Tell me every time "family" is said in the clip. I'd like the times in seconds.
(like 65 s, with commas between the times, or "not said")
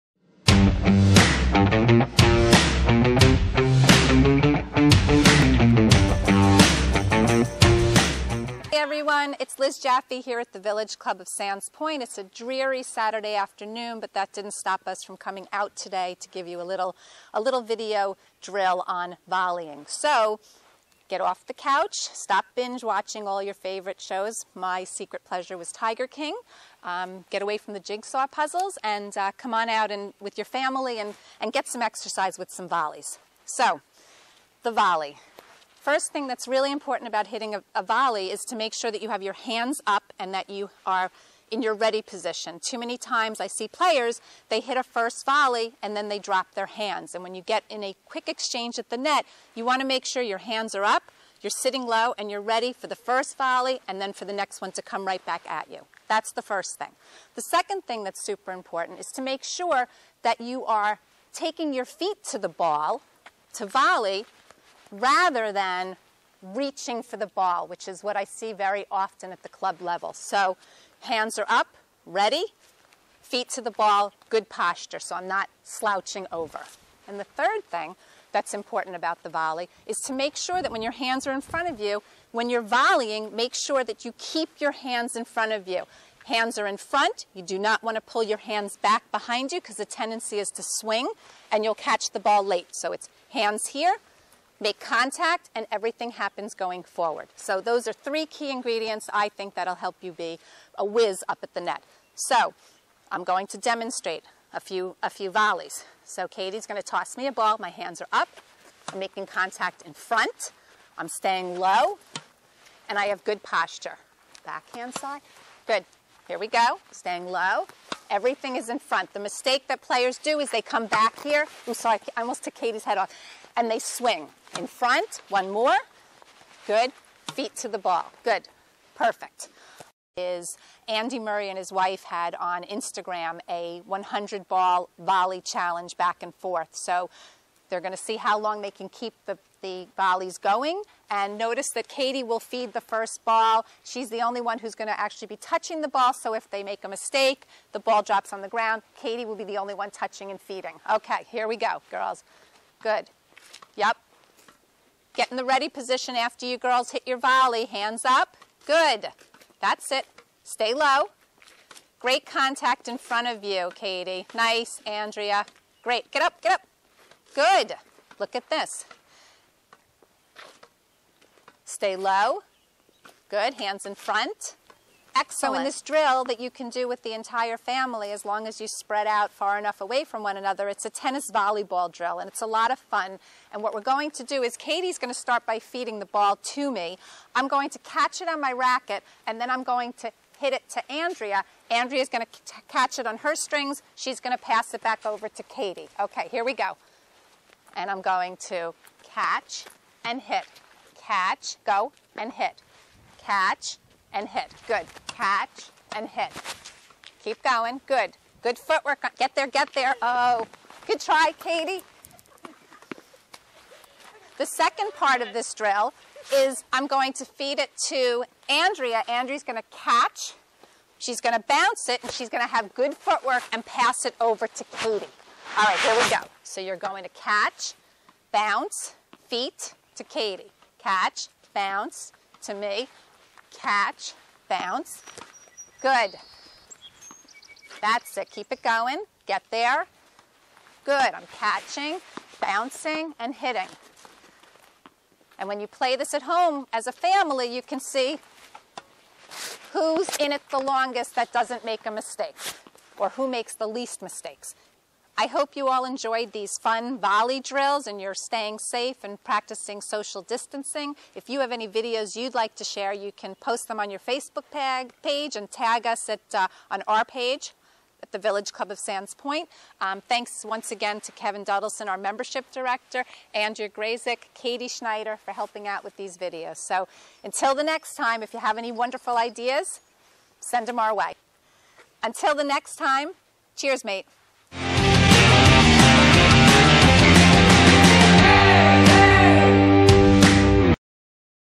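30 s, 177 s, 246 s.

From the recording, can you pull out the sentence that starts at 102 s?
So I'm going to demonstrate a few, a few volleys.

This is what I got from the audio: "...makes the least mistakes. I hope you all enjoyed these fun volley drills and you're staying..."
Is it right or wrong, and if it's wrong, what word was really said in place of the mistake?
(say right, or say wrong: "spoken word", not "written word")
right.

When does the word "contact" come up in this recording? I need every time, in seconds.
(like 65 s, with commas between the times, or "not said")
94 s, 109 s, 162 s.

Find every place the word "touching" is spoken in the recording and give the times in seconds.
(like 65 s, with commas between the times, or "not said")
145 s, 149 s.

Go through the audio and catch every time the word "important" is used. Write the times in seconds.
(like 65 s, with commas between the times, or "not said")
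36 s, 58 s, 78 s.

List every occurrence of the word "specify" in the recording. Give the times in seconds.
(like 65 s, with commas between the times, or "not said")
not said.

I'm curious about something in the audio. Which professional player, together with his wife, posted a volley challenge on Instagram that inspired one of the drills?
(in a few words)
Andy Murray.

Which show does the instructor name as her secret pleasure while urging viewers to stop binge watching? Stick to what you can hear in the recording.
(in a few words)
Tiger King.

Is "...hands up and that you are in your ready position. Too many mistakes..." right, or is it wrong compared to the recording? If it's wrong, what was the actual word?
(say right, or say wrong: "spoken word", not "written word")
wrong: "times", not "mistakes".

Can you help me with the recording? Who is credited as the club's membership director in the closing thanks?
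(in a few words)
Kevin Duddleson.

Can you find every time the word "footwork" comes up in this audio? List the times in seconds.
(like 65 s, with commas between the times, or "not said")
208 s, 222 s.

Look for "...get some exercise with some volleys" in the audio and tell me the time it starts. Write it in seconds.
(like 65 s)
31 s.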